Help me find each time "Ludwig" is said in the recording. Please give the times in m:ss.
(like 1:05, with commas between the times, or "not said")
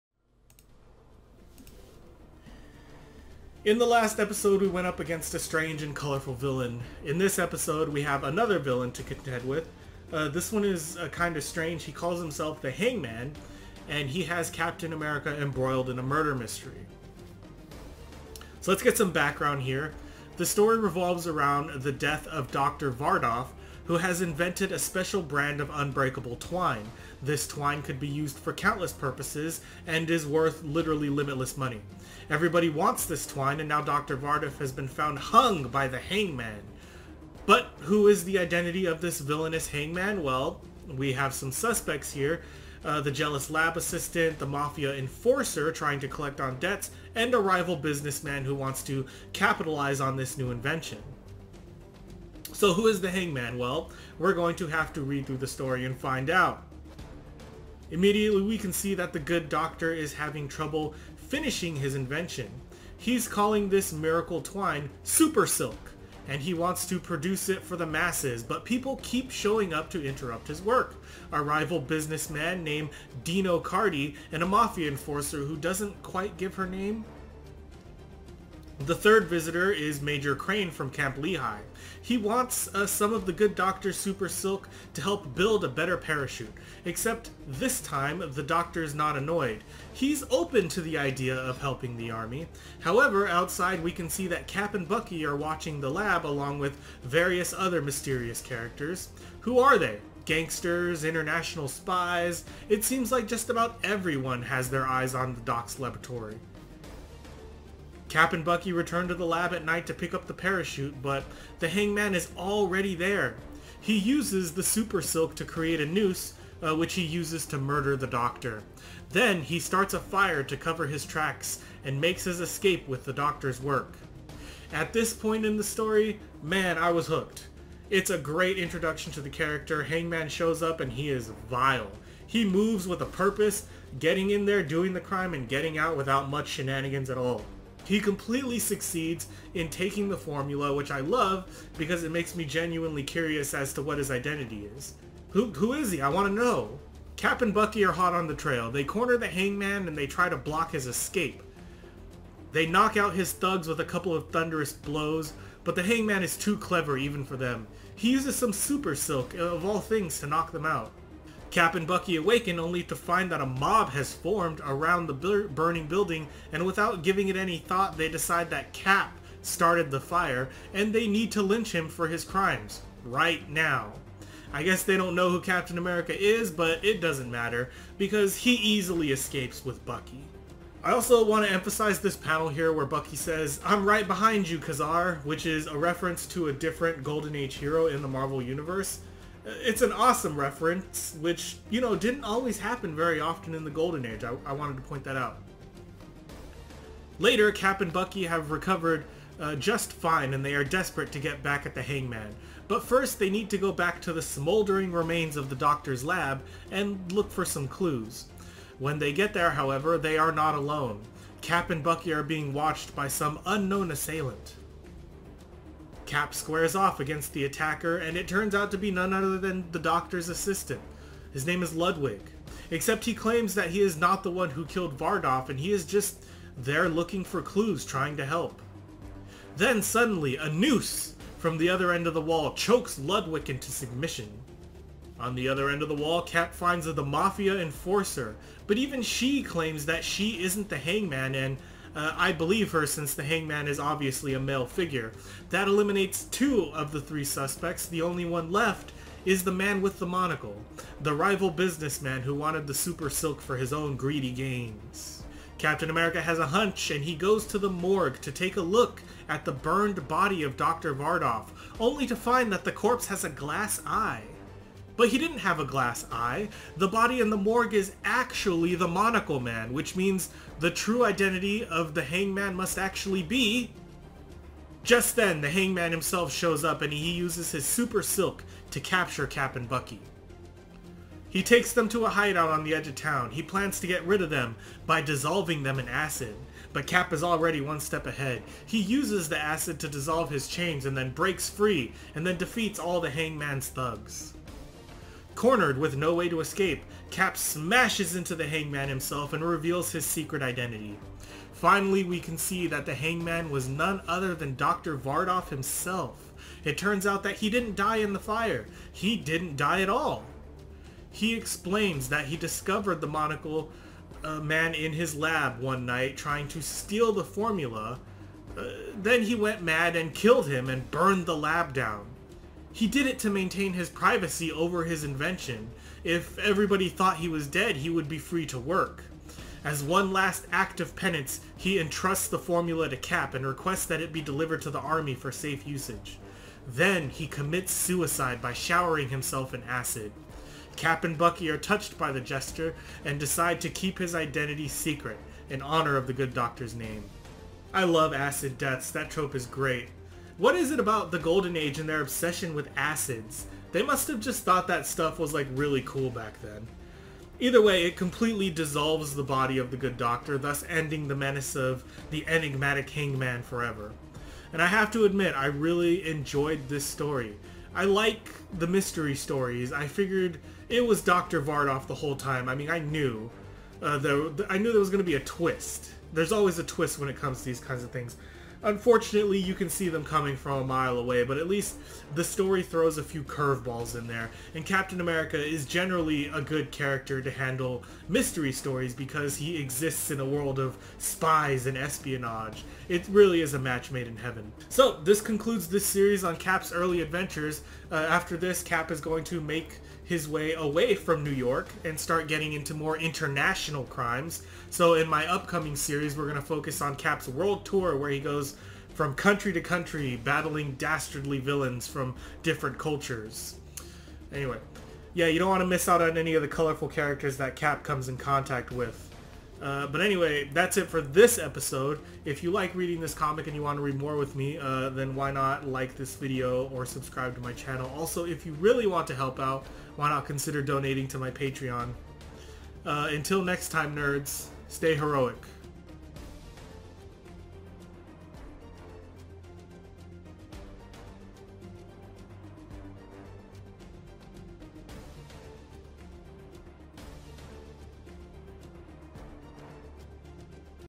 3:41, 3:52.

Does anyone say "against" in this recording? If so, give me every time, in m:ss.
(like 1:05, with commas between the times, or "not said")
0:04, 3:36.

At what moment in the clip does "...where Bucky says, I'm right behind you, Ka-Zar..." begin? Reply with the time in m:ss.
3:02.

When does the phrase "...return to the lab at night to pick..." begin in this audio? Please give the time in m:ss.
1:48.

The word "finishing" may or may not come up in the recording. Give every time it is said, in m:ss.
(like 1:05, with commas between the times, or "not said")
1:01.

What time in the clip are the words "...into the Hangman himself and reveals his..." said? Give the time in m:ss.
4:58.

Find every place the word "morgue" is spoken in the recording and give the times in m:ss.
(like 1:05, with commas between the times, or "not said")
4:17, 4:27.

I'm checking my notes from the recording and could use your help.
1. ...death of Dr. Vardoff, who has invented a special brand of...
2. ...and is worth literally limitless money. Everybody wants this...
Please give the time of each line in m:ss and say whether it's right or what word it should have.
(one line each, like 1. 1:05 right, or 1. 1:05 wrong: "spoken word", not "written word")
1. 0:21 right
2. 0:29 right.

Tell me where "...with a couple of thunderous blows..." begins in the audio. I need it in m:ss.
2:33.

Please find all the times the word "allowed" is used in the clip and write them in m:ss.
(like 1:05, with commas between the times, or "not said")
not said.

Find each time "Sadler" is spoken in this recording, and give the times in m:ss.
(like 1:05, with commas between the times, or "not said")
not said.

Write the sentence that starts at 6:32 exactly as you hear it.
It really is a match made in heaven.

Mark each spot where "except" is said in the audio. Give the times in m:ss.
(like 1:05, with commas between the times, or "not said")
1:26, 3:42.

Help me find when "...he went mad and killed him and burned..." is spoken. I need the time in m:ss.
5:19.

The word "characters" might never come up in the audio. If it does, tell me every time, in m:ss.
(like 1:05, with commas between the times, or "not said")
1:38, 2:09, 6:26, 6:56.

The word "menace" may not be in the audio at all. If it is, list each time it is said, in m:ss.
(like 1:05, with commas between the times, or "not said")
6:01.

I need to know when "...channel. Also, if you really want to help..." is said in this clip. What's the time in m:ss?
7:07.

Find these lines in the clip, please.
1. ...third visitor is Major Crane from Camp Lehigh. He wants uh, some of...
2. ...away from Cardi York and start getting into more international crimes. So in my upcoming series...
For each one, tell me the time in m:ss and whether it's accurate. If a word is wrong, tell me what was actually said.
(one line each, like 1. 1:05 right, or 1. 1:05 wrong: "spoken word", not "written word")
1. 1:18 right
2. 6:40 wrong: "New", not "Cardi".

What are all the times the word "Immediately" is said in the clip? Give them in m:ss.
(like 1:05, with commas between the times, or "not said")
0:57.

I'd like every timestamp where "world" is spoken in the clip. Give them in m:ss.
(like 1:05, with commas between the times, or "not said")
6:30, 6:47.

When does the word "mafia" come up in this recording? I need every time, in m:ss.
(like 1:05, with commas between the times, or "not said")
0:44, 1:14, 3:57.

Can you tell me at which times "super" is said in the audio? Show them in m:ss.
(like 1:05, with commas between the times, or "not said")
1:05, 1:23, 1:54, 2:38, 4:12, 4:37.